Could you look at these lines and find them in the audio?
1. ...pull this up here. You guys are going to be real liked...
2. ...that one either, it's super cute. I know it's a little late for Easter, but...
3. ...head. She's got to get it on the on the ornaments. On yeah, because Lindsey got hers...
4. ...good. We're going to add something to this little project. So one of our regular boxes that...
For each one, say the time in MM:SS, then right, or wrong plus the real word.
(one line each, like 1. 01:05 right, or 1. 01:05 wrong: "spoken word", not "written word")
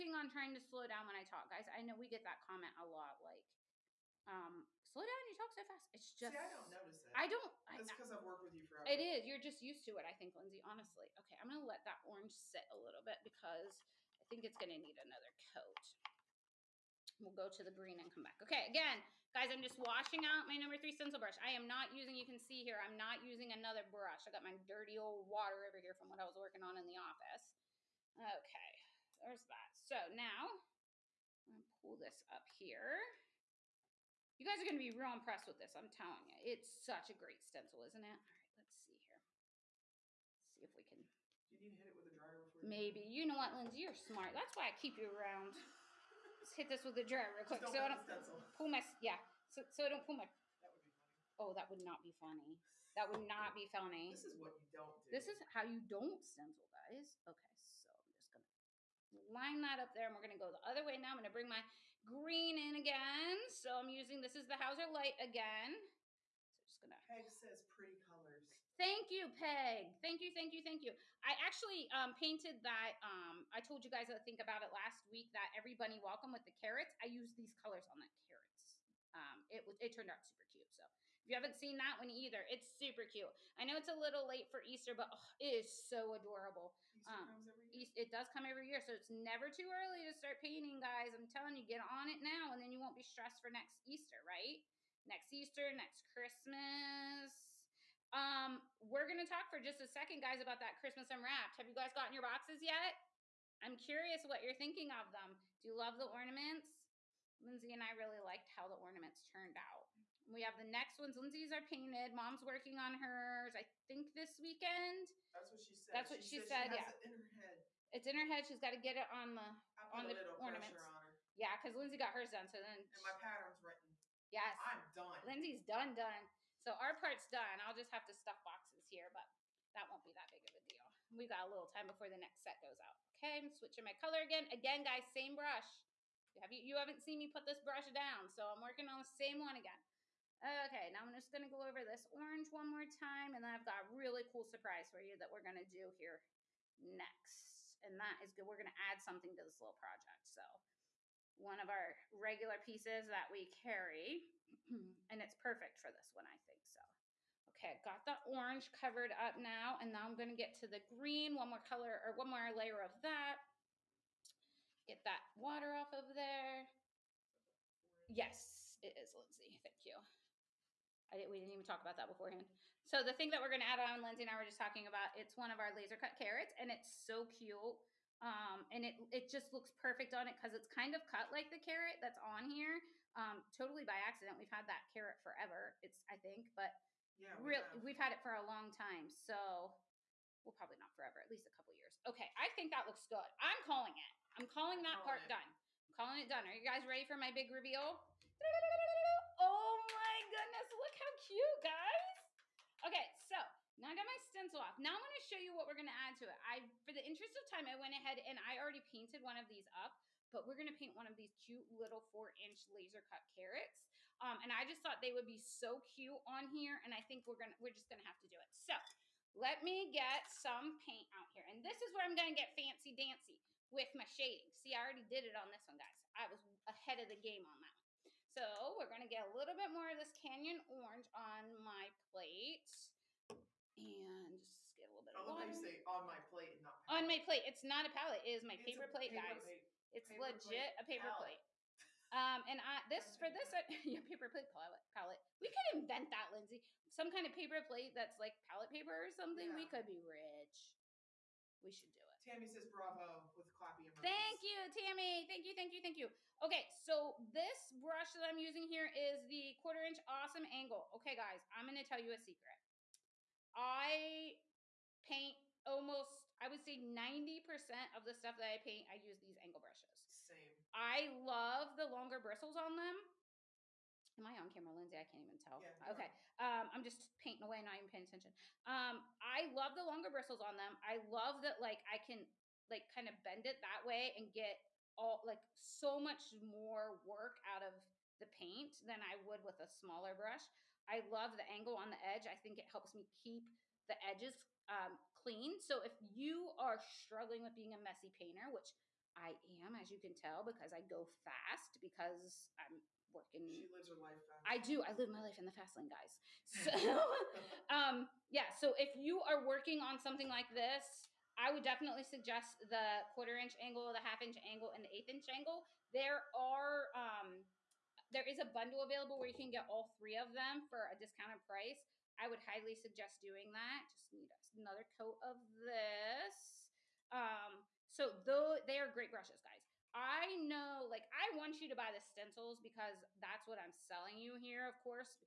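1. 00:31 wrong: "impressed", not "liked"
2. 01:21 right
3. 01:58 right
4. 02:28 wrong: "pieces", not "boxes".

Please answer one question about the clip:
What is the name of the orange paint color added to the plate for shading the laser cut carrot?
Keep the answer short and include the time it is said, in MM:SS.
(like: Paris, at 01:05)
Canyon Orange, at 03:50.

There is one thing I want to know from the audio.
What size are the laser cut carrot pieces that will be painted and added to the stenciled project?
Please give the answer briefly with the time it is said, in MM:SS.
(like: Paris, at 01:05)
4 inch, at 03:32.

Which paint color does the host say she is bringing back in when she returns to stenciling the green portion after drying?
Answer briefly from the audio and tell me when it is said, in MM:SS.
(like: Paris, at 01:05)
Hauser light, at 01:04.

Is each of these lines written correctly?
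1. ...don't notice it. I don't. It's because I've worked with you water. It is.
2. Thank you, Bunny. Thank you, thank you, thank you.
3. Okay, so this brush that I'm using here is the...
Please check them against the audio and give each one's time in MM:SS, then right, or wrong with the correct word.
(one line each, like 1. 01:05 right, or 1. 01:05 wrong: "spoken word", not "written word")
1. 00:06 wrong: "forever", not "water"
2. 01:08 wrong: "Peg", not "Bunny"
3. 04:16 right.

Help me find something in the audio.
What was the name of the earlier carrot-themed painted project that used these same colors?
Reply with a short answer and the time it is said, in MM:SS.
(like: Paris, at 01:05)
Every Bunny Welcome, at 01:15.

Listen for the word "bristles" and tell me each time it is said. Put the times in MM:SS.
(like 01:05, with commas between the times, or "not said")
04:32, 04:40.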